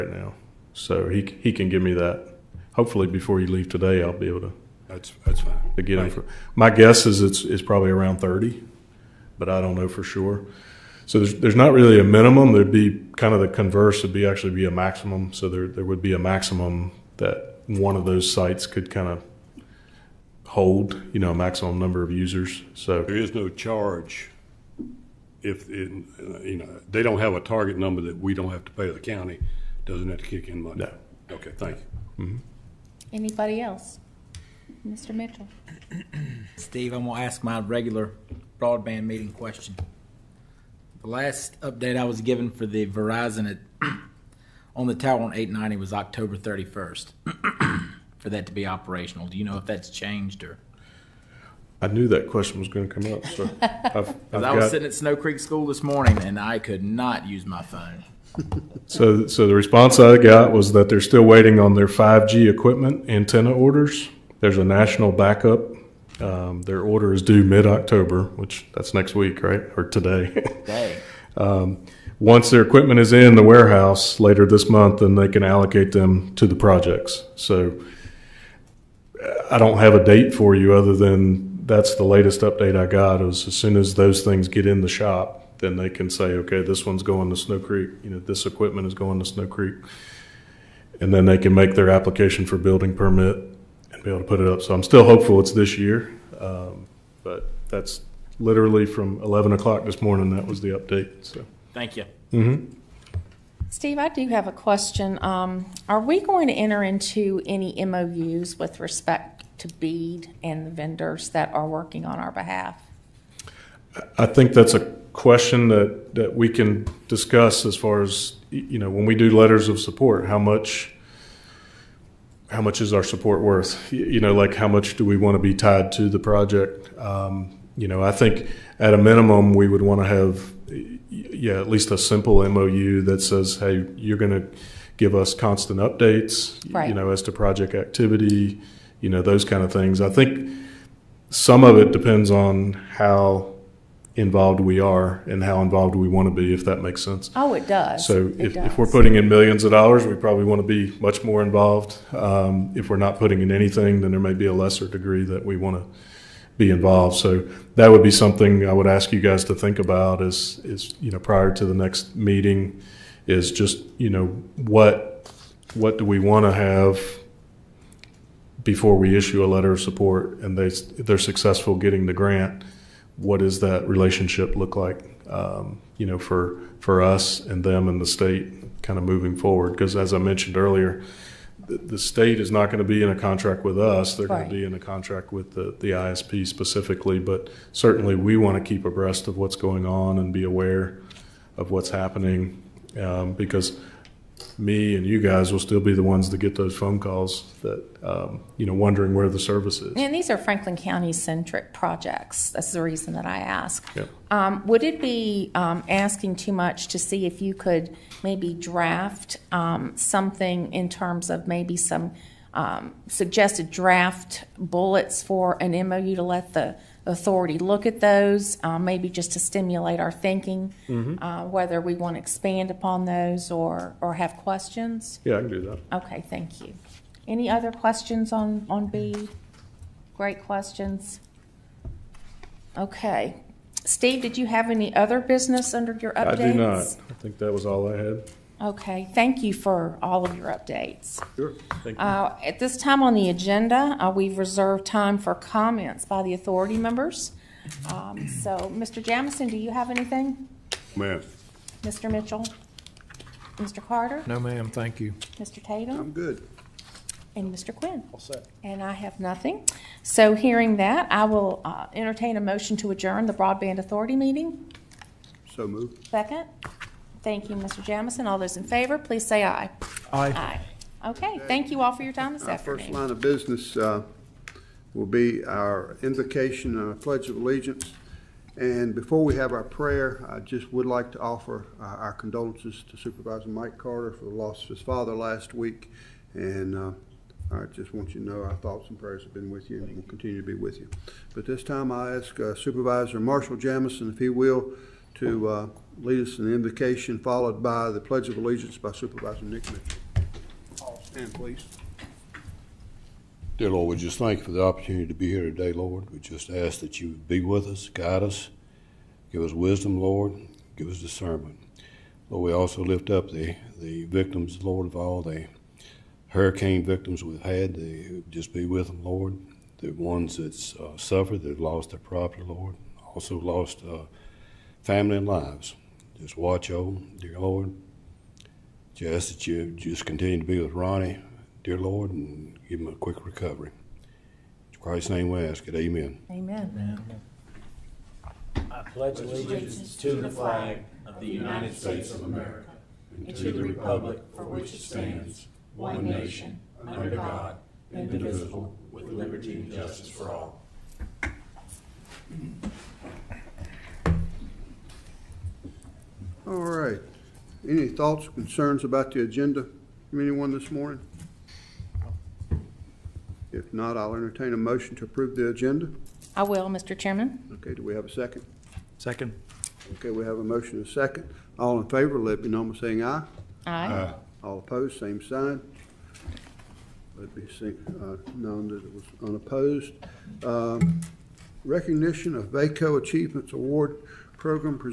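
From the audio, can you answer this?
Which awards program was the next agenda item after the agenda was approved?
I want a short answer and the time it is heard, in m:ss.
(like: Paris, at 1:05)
VACO Achievements Award, at 6:22.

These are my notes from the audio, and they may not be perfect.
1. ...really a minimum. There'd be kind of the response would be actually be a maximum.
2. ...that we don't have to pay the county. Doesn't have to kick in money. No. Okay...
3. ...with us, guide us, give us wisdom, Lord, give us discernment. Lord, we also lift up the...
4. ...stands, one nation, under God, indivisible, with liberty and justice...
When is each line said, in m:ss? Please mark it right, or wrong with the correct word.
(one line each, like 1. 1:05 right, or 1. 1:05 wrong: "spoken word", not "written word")
1. 0:11 wrong: "converse", not "response"
2. 0:28 right
3. 5:07 right
4. 5:44 right.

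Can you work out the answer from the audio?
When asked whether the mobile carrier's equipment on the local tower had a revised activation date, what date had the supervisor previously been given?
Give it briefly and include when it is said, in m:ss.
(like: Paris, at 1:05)
October 31st, at 0:45.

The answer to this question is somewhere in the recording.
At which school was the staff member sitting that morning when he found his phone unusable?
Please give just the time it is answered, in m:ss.
0:54.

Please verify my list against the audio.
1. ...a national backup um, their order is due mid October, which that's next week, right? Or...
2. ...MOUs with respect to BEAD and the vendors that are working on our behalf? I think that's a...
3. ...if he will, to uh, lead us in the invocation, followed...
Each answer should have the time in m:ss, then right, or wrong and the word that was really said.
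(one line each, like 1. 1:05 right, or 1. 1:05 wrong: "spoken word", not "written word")
1. 1:04 right
2. 1:47 right
3. 4:54 right.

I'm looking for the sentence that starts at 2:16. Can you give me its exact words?
you know, as to project activity, you know, those kind of things.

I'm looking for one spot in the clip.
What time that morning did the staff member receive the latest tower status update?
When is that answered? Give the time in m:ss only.
1:39.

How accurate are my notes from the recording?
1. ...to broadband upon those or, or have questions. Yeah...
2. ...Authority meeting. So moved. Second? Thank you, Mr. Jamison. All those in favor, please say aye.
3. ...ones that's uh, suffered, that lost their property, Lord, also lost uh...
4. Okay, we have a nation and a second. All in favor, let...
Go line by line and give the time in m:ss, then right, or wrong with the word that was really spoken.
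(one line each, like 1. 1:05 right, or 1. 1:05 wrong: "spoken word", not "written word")
1. 3:42 wrong: "expand", not "broadband"
2. 4:23 right
3. 5:19 right
4. 6:09 wrong: "motion", not "nation".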